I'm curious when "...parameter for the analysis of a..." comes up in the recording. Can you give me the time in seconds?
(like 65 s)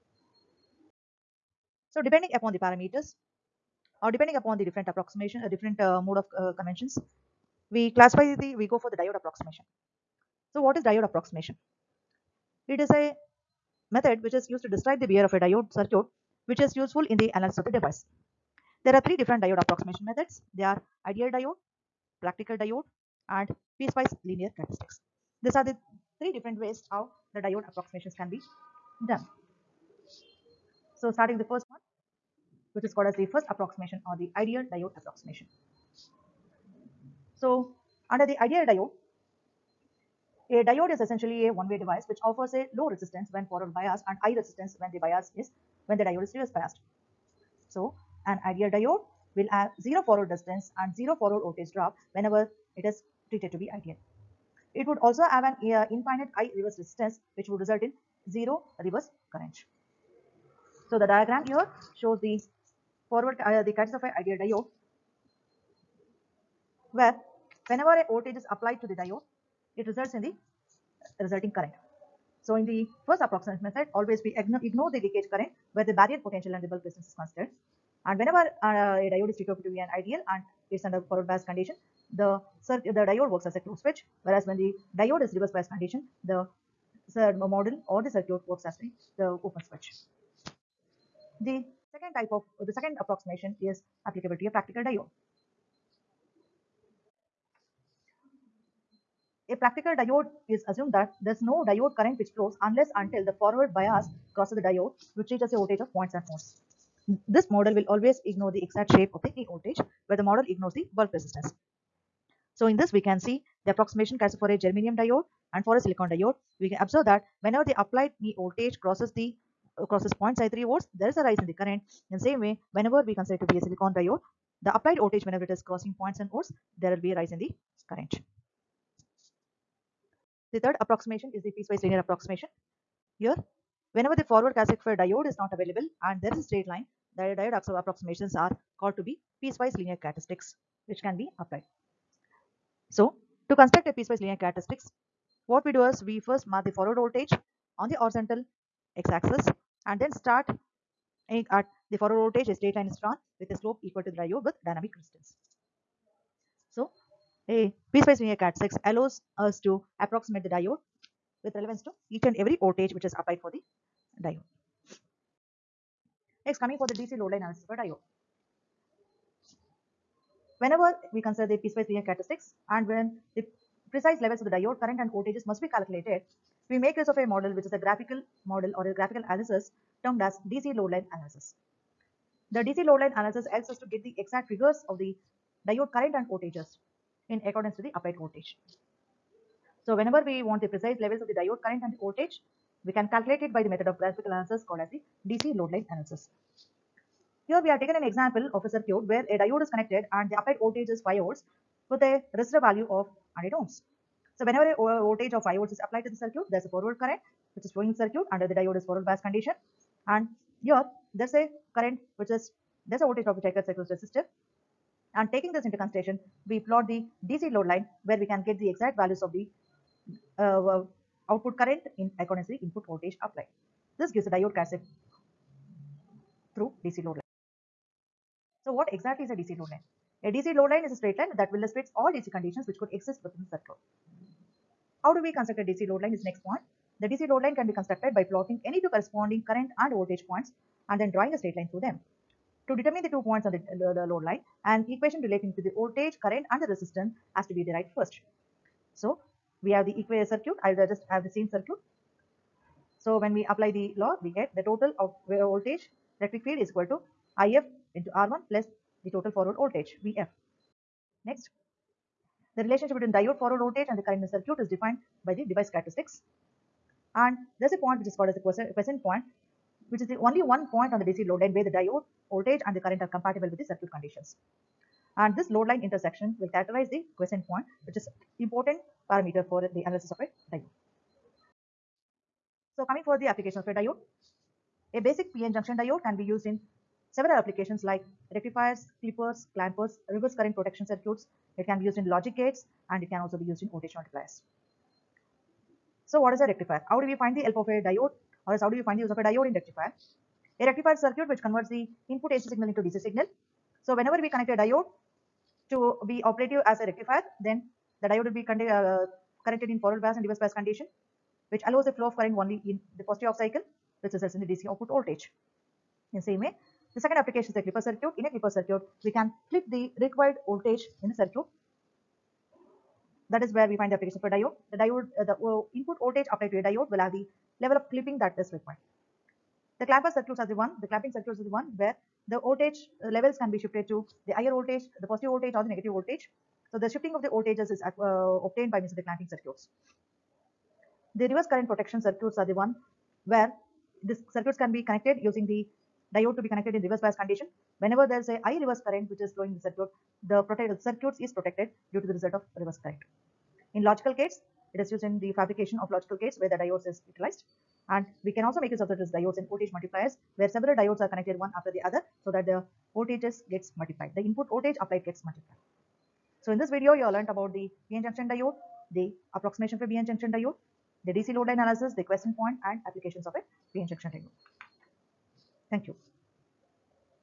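279 s.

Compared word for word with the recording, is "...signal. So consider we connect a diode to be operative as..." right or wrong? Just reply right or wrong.
wrong.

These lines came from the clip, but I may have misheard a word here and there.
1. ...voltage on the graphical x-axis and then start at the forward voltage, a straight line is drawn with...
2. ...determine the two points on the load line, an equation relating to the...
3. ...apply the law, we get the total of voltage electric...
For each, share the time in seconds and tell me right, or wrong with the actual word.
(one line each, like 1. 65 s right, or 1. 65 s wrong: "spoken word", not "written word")
1. 146 s wrong: "horizontal", not "graphical"
2. 242 s right
3. 253 s right.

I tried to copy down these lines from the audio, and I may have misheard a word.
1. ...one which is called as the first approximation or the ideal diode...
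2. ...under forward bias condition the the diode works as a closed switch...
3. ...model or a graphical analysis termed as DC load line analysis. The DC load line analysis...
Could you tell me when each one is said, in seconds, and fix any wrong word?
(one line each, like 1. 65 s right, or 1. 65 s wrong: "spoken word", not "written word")
1. 31 s right
2. 80 s right
3. 178 s right.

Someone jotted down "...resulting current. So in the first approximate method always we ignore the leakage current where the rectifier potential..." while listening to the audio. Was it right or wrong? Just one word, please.
wrong.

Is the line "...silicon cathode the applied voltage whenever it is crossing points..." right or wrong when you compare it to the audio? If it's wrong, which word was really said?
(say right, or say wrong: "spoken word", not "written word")
wrong: "diode", not "cathode".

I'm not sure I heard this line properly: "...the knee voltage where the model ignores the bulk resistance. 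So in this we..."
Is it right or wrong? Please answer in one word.
right.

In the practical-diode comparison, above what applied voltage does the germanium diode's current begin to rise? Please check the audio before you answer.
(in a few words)
0.53 volts.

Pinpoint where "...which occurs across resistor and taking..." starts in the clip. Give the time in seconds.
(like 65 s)
213 s.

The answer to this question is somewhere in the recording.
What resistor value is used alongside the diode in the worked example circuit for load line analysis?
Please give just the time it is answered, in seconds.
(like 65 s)
203 s.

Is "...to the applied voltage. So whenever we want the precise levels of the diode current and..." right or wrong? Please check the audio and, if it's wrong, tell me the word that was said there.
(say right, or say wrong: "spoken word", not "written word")
right.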